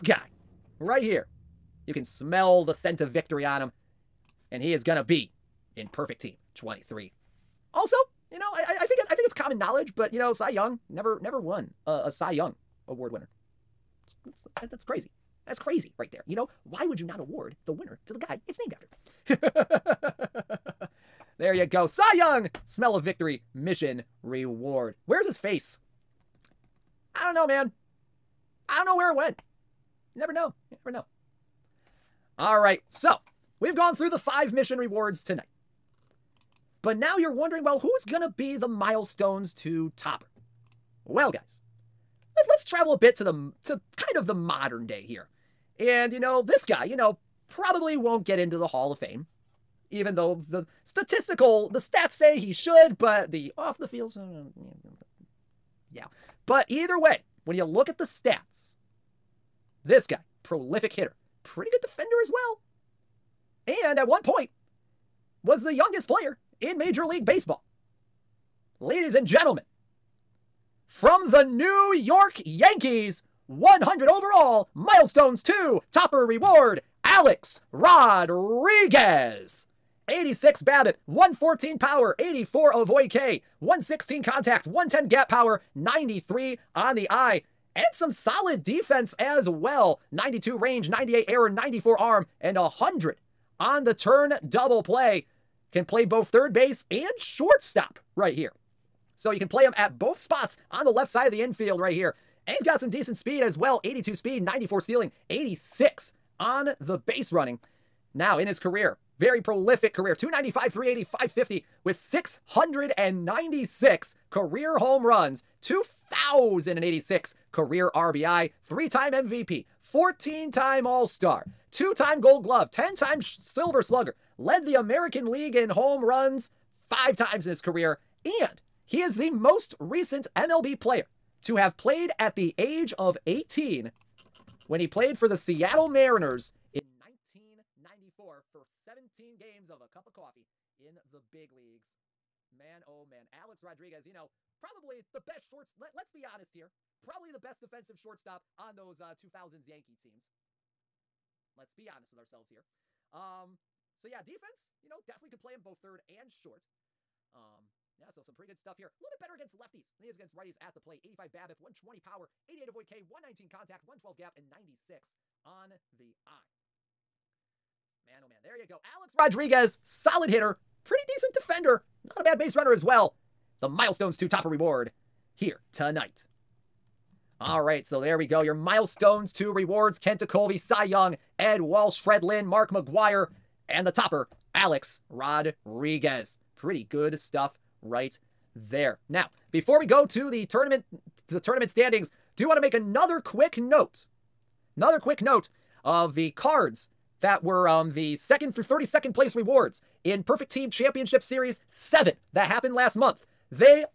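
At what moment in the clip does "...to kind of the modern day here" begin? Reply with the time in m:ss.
0:43.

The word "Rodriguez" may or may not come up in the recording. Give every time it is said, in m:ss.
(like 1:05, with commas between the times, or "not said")
1:17, 2:23, 2:49, 3:05.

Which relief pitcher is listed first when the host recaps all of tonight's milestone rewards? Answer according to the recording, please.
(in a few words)
Kent Tekulve.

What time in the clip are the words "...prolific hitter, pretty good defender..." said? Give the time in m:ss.
1:00.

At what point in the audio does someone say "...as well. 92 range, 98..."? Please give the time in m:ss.
1:29.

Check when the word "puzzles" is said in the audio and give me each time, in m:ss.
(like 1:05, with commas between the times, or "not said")
not said.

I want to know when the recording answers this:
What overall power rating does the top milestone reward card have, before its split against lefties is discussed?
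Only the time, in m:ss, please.
1:21.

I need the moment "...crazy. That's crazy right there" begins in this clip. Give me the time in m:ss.
0:14.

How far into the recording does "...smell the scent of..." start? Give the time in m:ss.
0:02.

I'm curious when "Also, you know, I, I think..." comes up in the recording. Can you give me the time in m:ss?
0:07.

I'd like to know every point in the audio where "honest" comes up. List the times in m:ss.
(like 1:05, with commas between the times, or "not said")
2:26, 2:31.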